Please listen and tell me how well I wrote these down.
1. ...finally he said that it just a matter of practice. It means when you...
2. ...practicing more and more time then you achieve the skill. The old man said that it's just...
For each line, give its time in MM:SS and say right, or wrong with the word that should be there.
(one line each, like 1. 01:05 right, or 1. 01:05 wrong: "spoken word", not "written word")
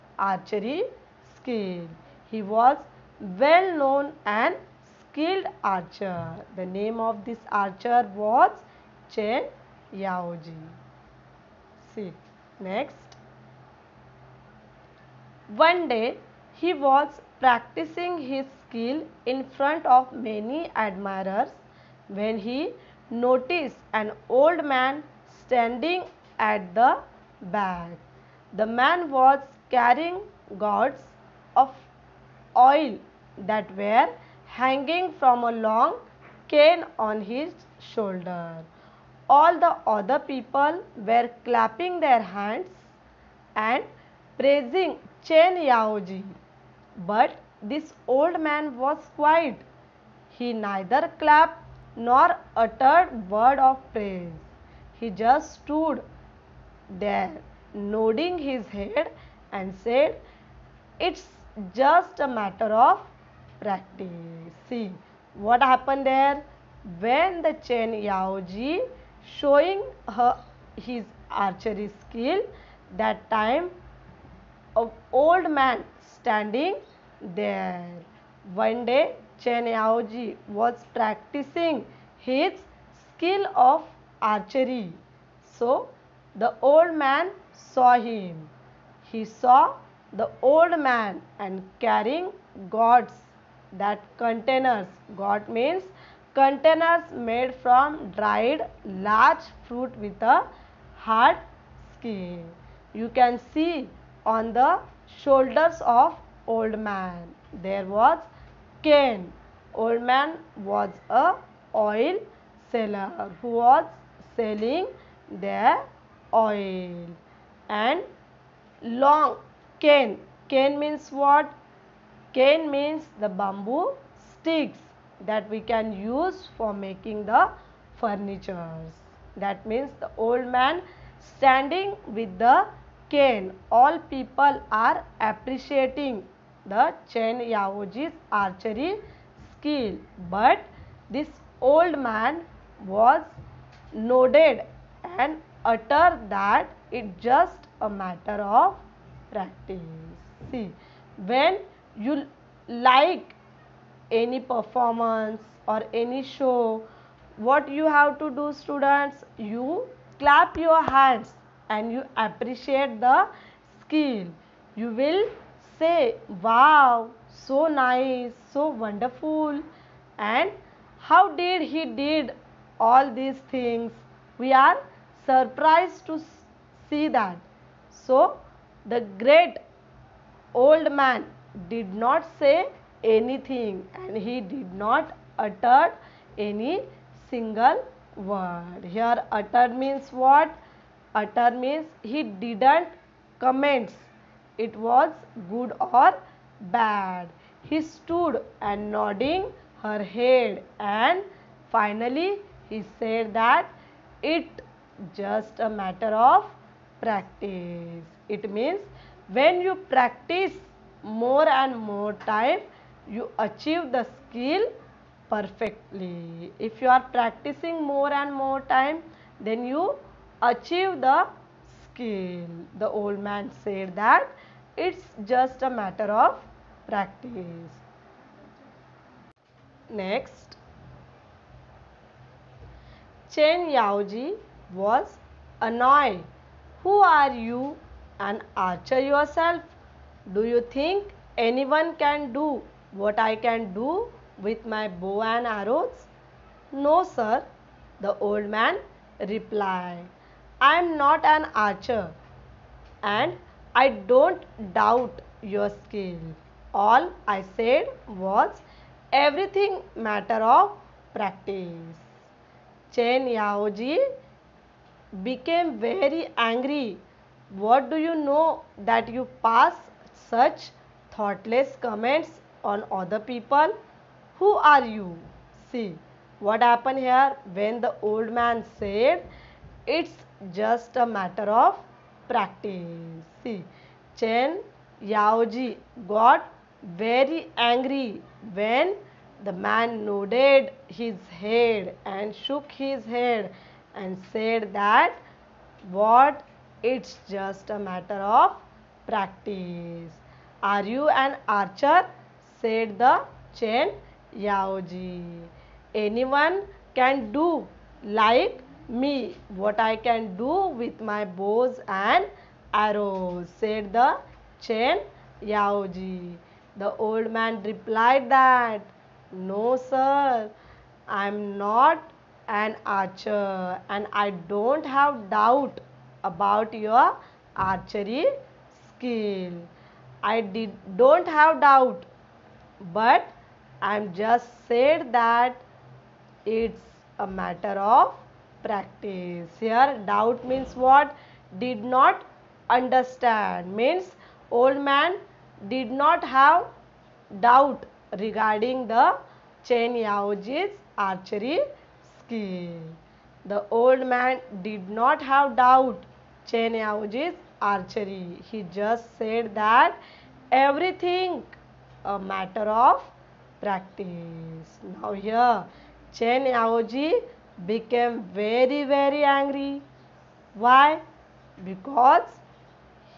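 1. 03:21 right
2. 03:37 right.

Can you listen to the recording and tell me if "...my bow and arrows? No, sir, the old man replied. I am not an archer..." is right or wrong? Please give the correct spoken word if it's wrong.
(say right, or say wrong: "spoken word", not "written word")
right.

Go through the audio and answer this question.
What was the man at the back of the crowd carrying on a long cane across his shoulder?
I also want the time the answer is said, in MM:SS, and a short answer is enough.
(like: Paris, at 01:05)
Gourds of oil, at 00:30.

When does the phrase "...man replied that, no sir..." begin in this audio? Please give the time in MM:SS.
05:17.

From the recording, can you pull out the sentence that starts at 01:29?
He saw the old man and carrying gourds that containers.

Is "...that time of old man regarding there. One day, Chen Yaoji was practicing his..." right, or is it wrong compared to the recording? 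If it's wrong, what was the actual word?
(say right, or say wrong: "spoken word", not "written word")
wrong: "standing", not "regarding".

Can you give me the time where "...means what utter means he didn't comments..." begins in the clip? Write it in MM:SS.
03:09.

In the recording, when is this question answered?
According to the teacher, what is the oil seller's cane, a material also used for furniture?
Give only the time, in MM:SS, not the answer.
02:03.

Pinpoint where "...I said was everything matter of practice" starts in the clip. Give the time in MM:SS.
04:17.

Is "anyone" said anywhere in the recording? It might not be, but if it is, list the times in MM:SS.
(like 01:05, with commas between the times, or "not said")
04:01, 05:05.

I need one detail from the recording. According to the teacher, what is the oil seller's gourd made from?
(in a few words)
Dried large fruit.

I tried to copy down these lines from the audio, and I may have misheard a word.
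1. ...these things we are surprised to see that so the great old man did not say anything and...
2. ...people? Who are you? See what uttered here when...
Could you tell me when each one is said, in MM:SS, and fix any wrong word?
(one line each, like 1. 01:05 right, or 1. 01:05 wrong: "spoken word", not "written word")
1. 02:53 right
2. 04:33 wrong: "happened", not "uttered".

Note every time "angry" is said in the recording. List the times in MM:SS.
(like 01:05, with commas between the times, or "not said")
04:26, 04:47, 06:09.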